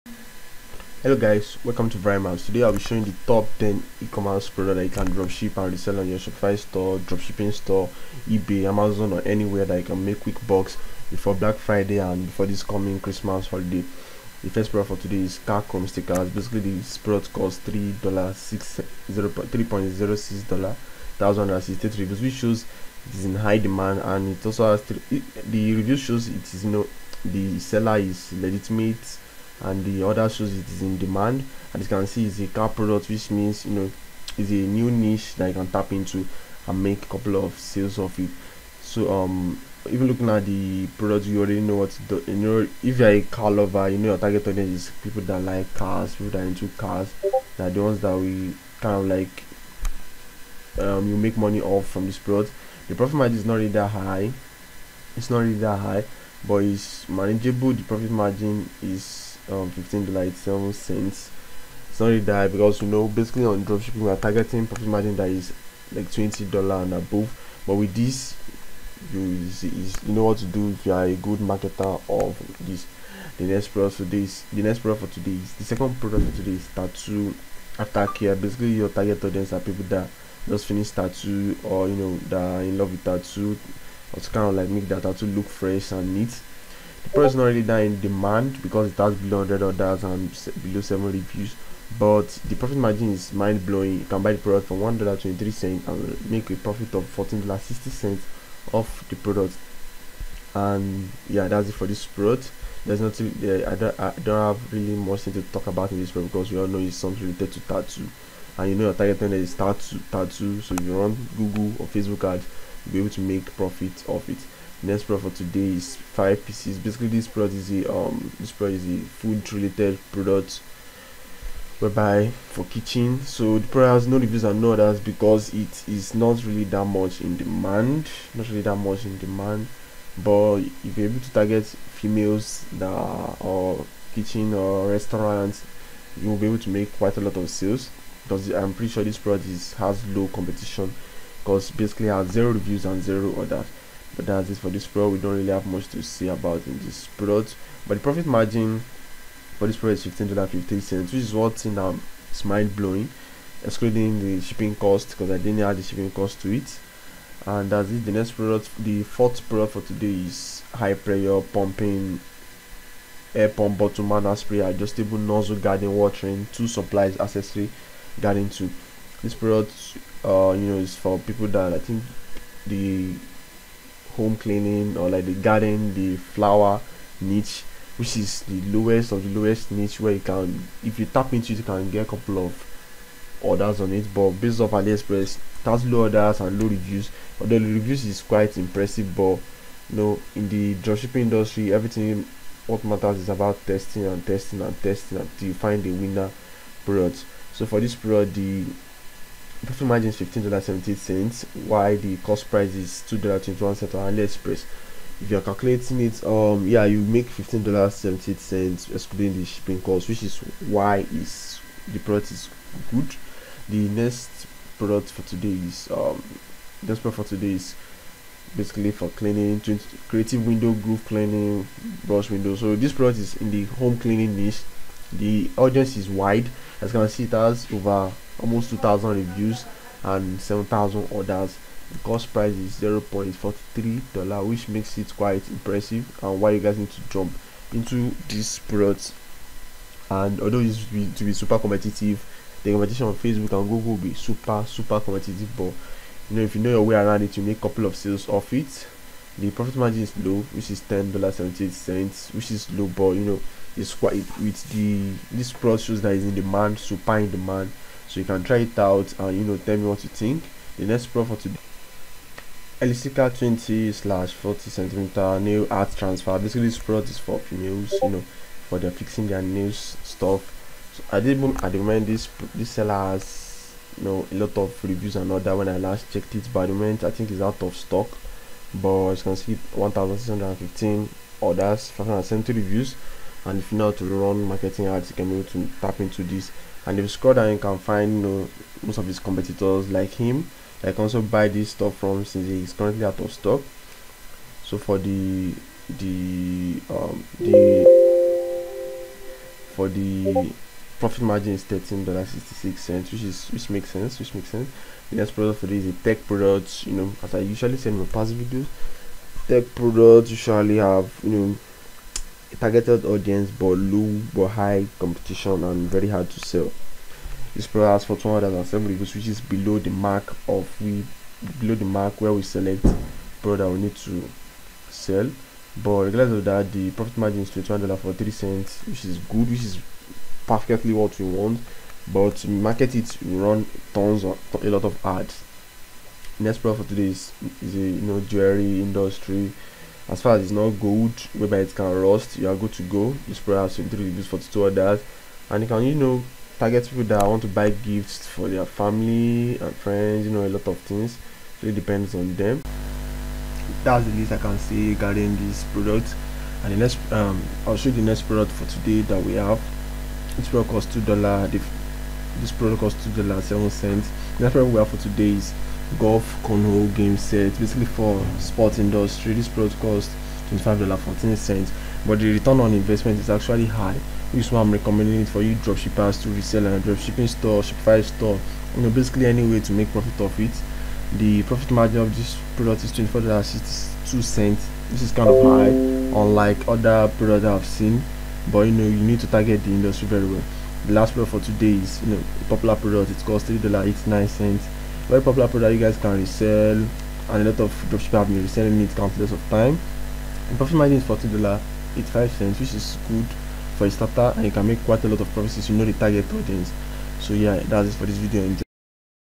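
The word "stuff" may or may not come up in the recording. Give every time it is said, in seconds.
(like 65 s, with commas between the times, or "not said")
270 s, 291 s.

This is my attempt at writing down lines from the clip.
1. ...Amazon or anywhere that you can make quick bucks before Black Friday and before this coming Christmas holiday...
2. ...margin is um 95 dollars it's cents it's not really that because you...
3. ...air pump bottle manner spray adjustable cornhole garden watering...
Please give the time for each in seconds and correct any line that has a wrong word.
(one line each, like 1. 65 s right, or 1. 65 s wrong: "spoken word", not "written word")
1. 8 s right
2. 58 s wrong: "15", not "95"
3. 163 s wrong: "nozzle", not "cornhole".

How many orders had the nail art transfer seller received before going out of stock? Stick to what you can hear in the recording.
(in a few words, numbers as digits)
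1615.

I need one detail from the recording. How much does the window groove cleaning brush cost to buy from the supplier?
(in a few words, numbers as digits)
$0.43.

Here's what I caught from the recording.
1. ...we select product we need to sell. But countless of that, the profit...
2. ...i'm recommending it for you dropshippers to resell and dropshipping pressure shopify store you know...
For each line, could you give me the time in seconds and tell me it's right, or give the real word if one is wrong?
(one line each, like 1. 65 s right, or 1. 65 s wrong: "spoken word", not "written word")
1. 322 s wrong: "regardless", not "countless"
2. 374 s wrong: "store", not "pressure".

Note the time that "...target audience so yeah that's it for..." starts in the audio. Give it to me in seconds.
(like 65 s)
405 s.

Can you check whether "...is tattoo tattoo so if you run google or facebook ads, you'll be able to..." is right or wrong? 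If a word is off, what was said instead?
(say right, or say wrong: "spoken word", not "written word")
right.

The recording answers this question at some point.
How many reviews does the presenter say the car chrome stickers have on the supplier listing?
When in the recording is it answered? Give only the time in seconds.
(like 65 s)
21 s.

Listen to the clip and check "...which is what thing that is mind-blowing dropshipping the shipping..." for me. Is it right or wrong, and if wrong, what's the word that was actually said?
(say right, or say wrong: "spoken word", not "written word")
wrong: "excluding", not "dropshipping".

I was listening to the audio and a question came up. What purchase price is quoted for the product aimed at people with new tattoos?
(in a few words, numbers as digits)
$1.23.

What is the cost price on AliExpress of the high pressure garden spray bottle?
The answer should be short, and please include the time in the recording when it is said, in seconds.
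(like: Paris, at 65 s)
$2.21, at 203 s.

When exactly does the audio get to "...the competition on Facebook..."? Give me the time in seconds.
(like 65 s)
242 s.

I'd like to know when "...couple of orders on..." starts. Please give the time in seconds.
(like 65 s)
182 s.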